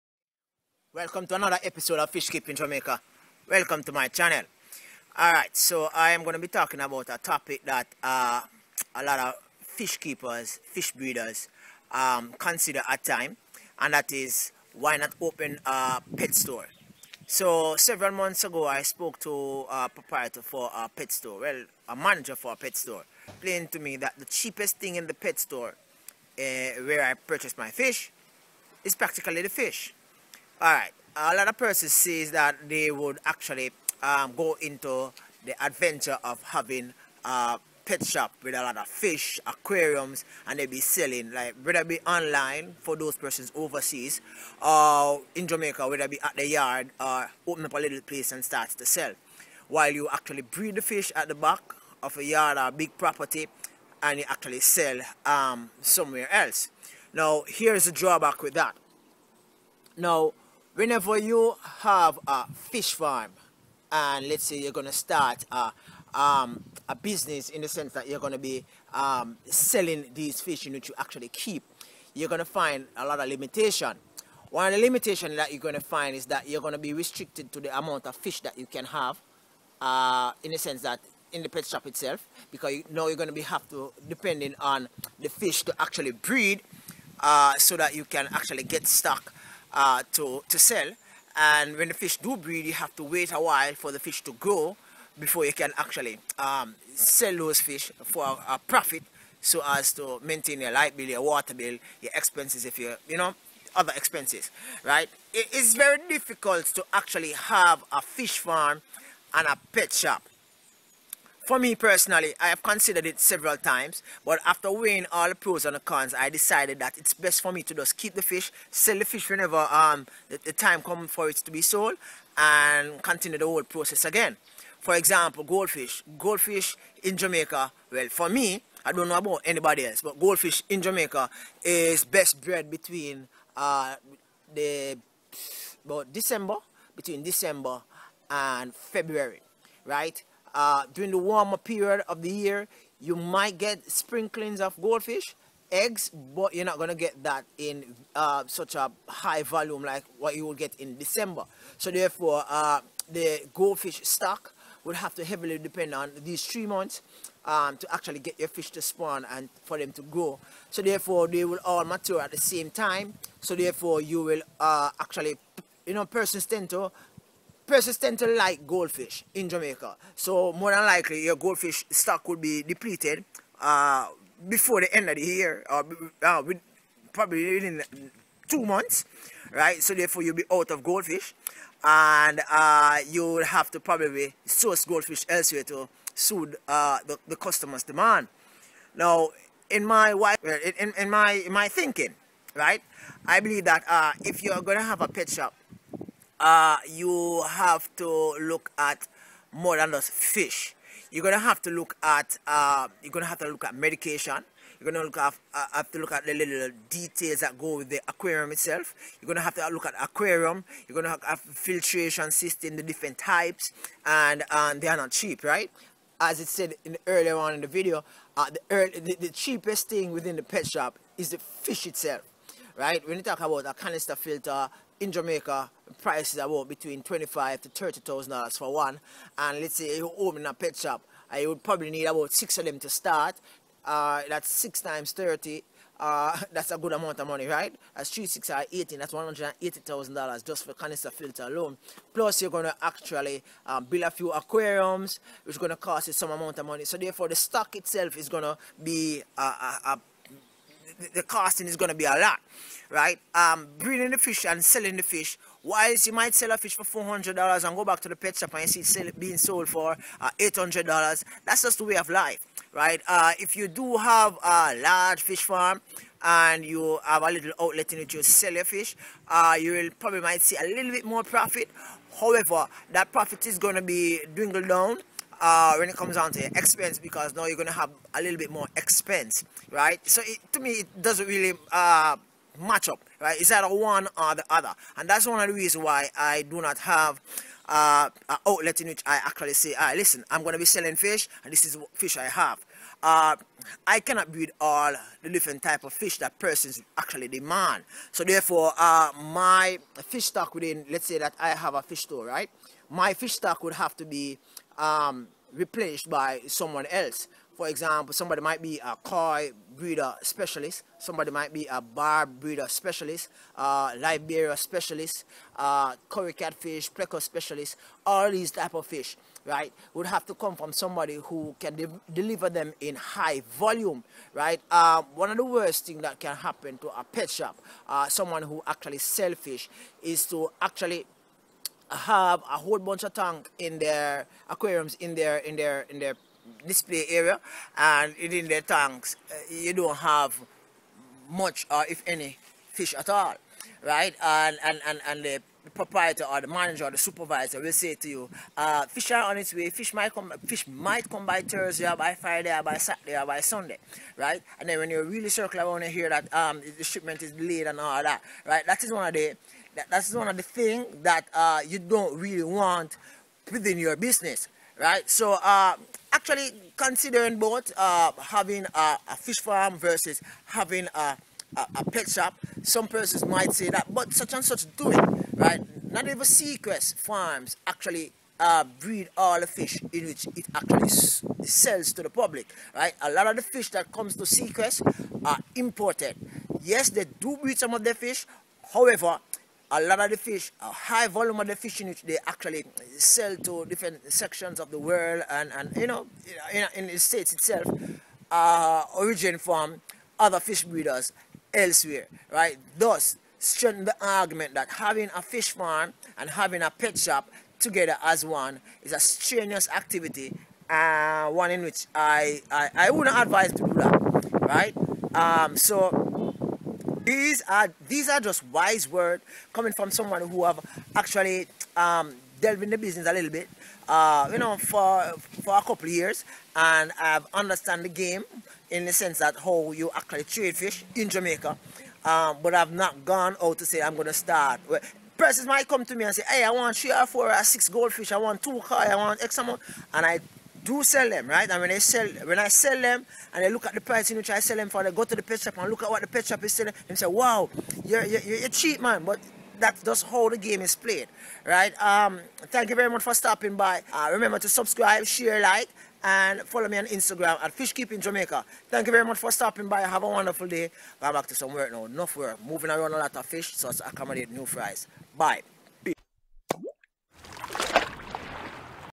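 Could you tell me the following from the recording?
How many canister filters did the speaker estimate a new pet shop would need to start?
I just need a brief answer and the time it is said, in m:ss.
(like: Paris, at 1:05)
6, at 3:52.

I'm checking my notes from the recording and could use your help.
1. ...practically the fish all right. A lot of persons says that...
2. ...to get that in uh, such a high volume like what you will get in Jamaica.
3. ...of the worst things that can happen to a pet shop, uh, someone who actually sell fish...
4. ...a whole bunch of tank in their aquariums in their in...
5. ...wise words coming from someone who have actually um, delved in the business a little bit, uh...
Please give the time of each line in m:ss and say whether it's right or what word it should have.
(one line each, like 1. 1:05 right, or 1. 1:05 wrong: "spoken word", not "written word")
1. 0:28 right
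2. 2:26 wrong: "December", not "Jamaica"
3. 5:25 right
4. 5:32 right
5. 6:58 right.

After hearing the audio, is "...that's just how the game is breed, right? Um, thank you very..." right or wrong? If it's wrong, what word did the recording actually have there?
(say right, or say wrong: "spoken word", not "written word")
wrong: "played", not "breed".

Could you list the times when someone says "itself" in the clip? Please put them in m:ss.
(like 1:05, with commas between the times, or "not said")
1:21, 3:28, 3:41, 4:07, 6:37.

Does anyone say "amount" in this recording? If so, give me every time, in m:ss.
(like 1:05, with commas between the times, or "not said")
1:17, 3:56, 4:06, 7:19.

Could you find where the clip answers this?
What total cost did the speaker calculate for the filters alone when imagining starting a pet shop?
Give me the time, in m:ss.
3:59.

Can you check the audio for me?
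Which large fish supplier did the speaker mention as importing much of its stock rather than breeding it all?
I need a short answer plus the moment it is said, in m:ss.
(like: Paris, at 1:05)
Segrest Farms, at 6:16.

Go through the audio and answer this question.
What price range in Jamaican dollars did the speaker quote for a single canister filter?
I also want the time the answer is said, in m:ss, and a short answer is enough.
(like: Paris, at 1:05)
25,000 to 30,000 dollars, at 3:47.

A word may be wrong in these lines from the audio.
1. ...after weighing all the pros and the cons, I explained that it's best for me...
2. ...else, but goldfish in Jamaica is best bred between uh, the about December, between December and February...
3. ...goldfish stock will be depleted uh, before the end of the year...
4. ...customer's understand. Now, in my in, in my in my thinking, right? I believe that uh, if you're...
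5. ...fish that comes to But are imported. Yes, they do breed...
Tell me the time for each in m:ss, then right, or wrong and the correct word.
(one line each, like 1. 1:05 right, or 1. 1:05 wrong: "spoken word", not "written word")
1. 1:54 wrong: "decided", not "explained"
2. 2:09 right
3. 2:51 right
4. 3:07 wrong: "demand", not "understand"
5. 6:23 wrong: "Segrest", not "But".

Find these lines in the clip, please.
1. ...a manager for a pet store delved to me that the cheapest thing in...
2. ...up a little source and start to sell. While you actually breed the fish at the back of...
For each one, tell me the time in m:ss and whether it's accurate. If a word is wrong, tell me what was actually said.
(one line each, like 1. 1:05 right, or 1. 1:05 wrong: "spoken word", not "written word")
1. 0:21 wrong: "explained", not "delved"
2. 0:47 wrong: "place", not "source".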